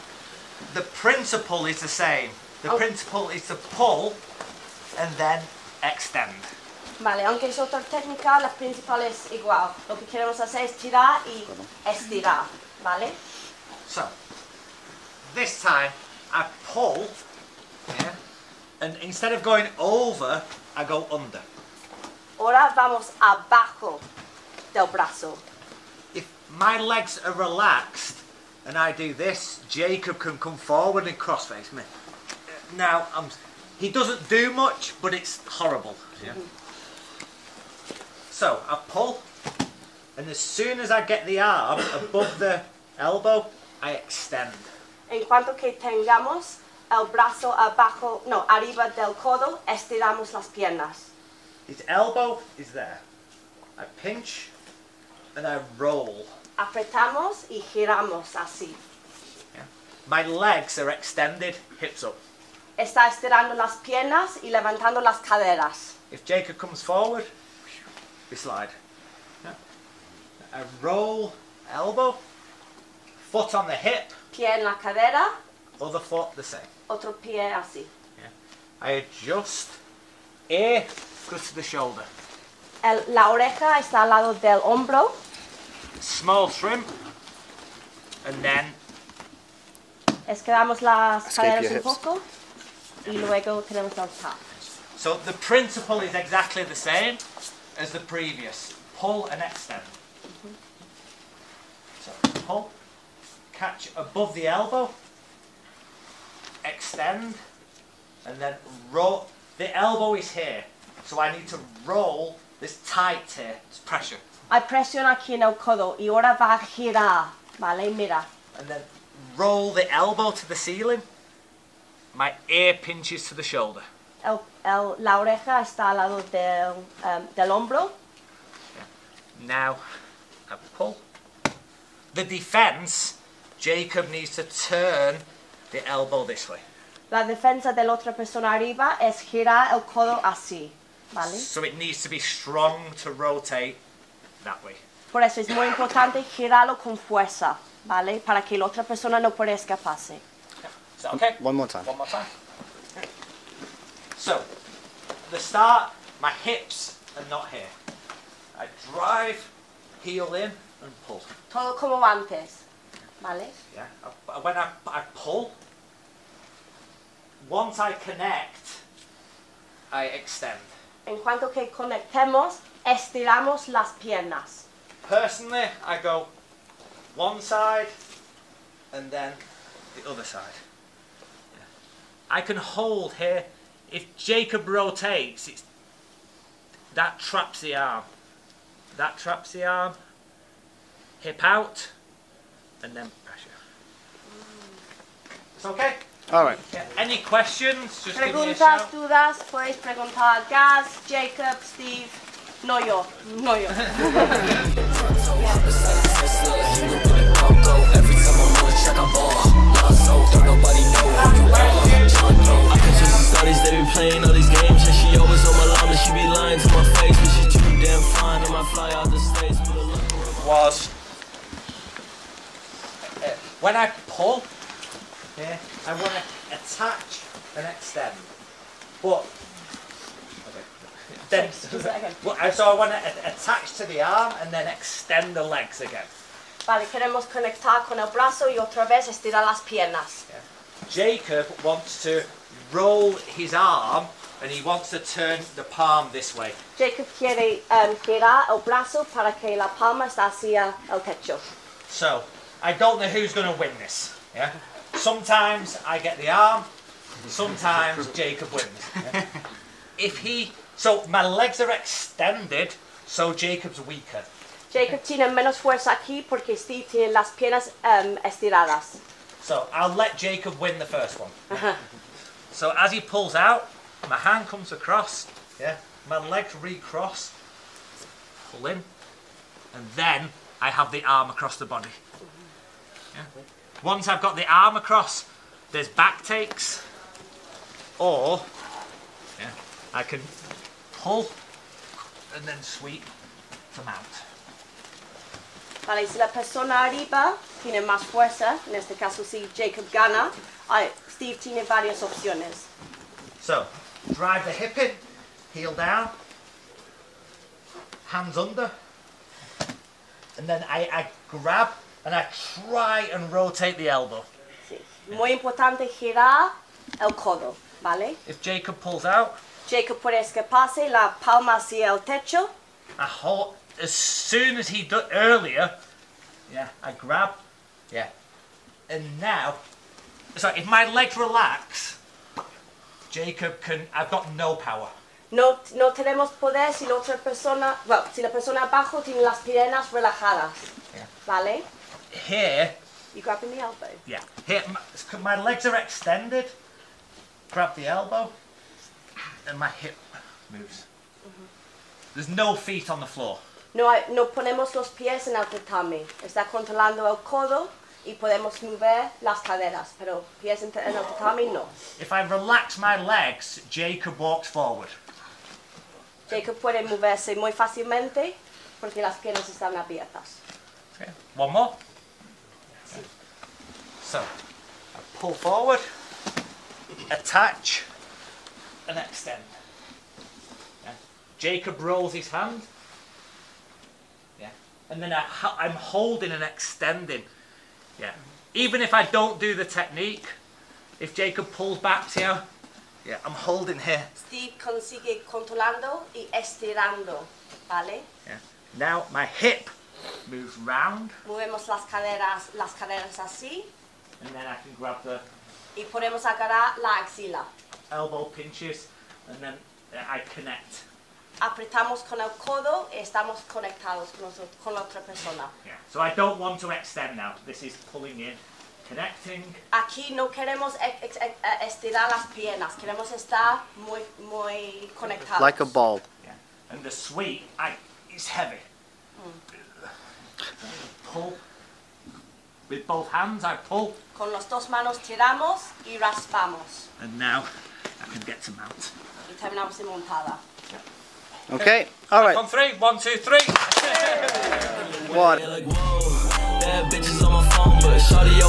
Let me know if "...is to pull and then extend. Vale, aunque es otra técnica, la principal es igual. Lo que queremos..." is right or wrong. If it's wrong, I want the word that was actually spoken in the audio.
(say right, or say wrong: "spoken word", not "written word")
right.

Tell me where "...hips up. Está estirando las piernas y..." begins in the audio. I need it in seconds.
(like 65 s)
61 s.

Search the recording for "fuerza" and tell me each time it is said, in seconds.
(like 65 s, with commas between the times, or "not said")
146 s, 265 s, 298 s.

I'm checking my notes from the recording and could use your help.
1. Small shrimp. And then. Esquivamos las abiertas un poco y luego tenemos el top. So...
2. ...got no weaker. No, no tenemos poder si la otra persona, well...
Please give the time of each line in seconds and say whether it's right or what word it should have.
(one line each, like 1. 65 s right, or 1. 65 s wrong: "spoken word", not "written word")
1. 86 s wrong: "caderas", not "abiertas"
2. 334 s wrong: "power", not "weaker".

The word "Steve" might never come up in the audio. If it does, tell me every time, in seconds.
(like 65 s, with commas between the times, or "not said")
201 s, 266 s, 301 s, 394 s.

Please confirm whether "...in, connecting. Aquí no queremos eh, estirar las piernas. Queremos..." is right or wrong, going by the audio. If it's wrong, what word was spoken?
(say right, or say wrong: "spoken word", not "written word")
right.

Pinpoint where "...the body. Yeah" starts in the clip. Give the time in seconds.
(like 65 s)
281 s.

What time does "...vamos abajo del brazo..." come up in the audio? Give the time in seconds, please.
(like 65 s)
22 s.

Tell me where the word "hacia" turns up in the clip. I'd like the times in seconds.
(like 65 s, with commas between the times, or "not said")
250 s, 321 s.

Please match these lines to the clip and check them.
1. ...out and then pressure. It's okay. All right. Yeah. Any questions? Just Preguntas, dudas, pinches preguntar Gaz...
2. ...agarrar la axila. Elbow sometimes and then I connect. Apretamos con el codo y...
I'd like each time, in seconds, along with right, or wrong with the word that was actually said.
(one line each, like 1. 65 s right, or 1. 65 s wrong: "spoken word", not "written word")
1. 191 s wrong: "puedes", not "pinches"
2. 406 s wrong: "pinches", not "sometimes".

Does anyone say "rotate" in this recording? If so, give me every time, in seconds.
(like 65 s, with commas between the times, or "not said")
143 s, 184 s, 313 s.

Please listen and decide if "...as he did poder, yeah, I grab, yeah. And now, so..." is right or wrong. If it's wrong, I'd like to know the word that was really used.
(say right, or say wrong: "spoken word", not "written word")
wrong: "earlier", not "poder".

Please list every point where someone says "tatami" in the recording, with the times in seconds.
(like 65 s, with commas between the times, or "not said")
355 s, 361 s.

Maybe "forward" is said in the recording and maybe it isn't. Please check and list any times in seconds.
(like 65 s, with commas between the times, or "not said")
30 s, 66 s, 364 s, 375 s.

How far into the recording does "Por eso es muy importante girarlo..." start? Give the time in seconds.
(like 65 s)
145 s.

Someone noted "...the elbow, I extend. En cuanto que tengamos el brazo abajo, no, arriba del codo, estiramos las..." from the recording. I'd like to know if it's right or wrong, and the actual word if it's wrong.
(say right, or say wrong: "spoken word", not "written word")
right.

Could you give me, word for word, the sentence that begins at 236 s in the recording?
Vale, queremos conectar con el brazo y otra vez estirar las piernas.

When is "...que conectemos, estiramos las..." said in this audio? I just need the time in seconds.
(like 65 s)
171 s.